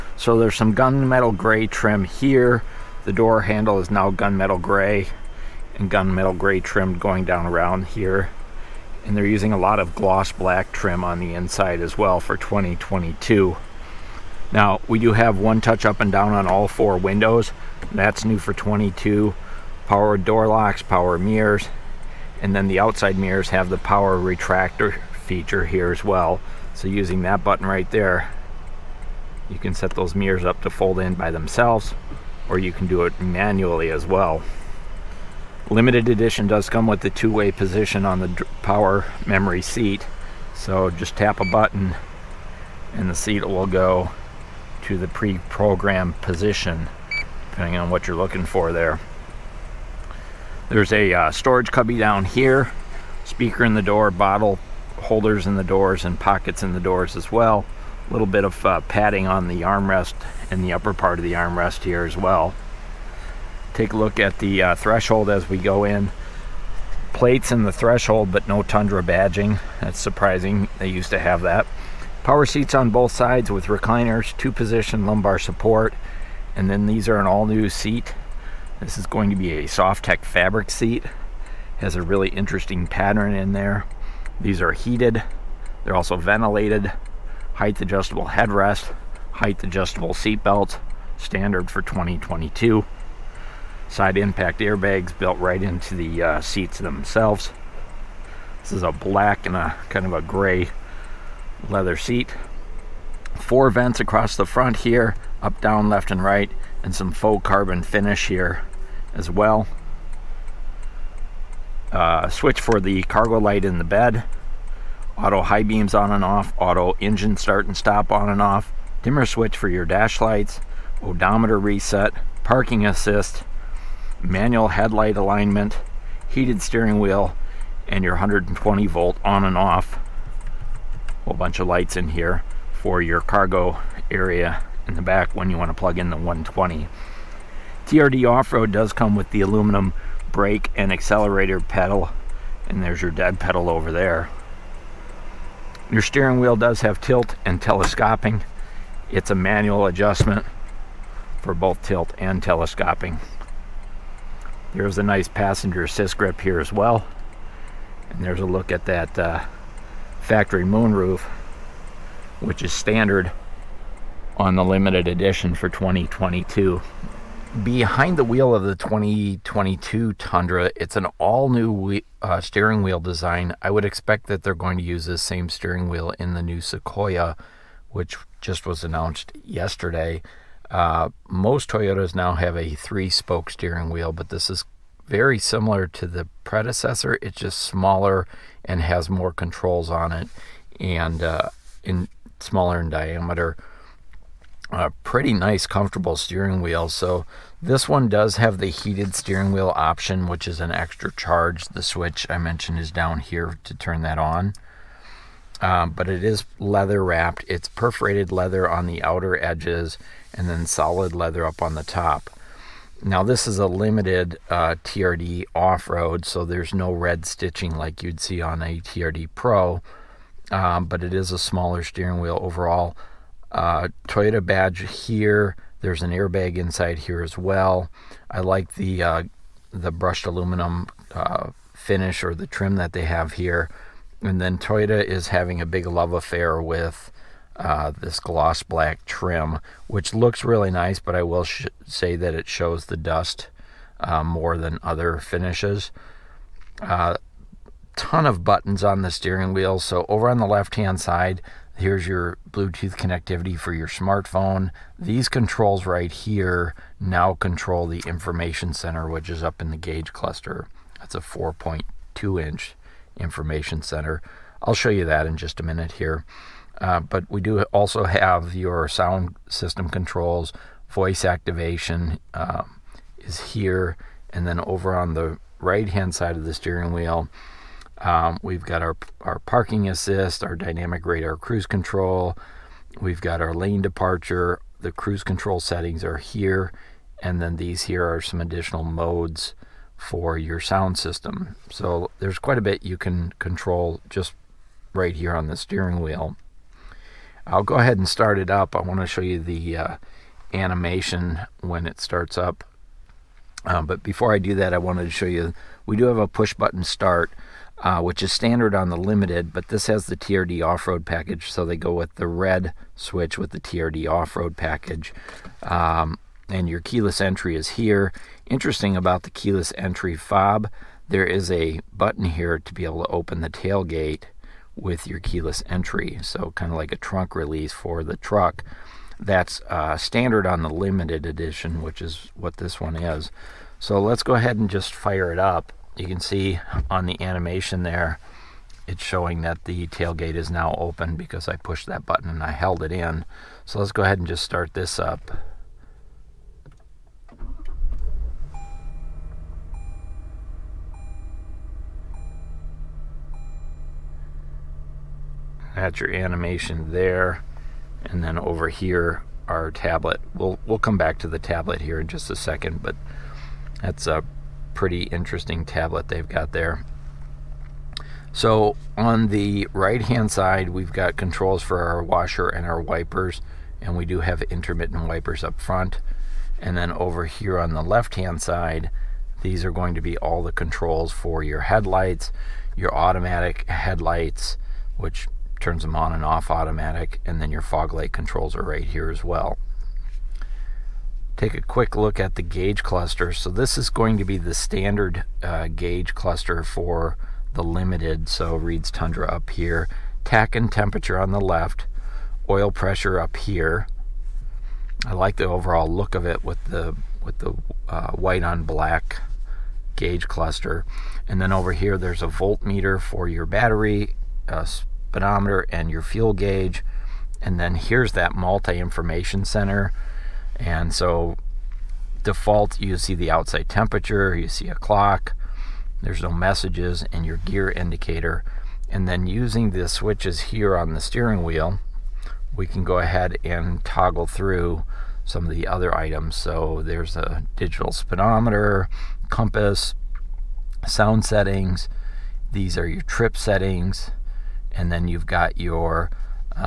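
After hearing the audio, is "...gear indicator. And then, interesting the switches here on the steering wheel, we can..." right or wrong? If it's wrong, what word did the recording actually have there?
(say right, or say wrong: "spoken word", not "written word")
wrong: "using", not "interesting".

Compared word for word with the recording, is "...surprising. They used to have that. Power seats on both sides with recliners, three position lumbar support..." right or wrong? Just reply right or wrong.
wrong.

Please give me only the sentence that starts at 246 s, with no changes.
Uh, ton of buttons on the steering wheel.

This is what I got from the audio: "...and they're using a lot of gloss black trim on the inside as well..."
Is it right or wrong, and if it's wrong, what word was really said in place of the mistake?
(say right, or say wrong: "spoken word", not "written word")
right.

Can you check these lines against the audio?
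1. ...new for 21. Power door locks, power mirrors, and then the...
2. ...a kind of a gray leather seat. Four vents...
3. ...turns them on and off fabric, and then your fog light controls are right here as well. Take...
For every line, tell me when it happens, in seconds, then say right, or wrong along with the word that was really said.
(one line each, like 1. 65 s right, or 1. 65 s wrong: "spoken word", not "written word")
1. 18 s wrong: "22", not "21"
2. 99 s right
3. 385 s wrong: "automatic", not "fabric".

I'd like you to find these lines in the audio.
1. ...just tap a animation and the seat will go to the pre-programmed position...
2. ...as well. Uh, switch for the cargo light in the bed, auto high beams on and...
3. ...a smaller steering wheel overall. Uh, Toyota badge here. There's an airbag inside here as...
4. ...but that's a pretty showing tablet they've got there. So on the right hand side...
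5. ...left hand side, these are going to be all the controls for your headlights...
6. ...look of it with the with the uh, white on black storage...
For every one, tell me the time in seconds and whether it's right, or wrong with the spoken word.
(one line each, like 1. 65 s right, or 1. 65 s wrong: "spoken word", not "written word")
1. 40 s wrong: "button", not "animation"
2. 109 s right
3. 221 s right
4. 362 s wrong: "interesting", not "showing"
5. 377 s right
6. 405 s wrong: "gauge", not "storage".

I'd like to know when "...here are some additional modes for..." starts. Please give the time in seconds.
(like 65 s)
287 s.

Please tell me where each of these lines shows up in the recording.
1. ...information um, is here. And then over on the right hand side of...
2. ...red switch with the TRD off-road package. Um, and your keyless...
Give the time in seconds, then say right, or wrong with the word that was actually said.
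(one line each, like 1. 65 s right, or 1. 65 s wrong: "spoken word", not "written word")
1. 271 s wrong: "activation", not "information"
2. 312 s right.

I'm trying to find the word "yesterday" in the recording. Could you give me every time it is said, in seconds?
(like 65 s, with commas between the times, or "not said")
179 s.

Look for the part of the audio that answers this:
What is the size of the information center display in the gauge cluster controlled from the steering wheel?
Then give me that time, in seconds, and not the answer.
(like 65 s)
261 s.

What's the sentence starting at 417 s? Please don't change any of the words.
And then here's that multi information center.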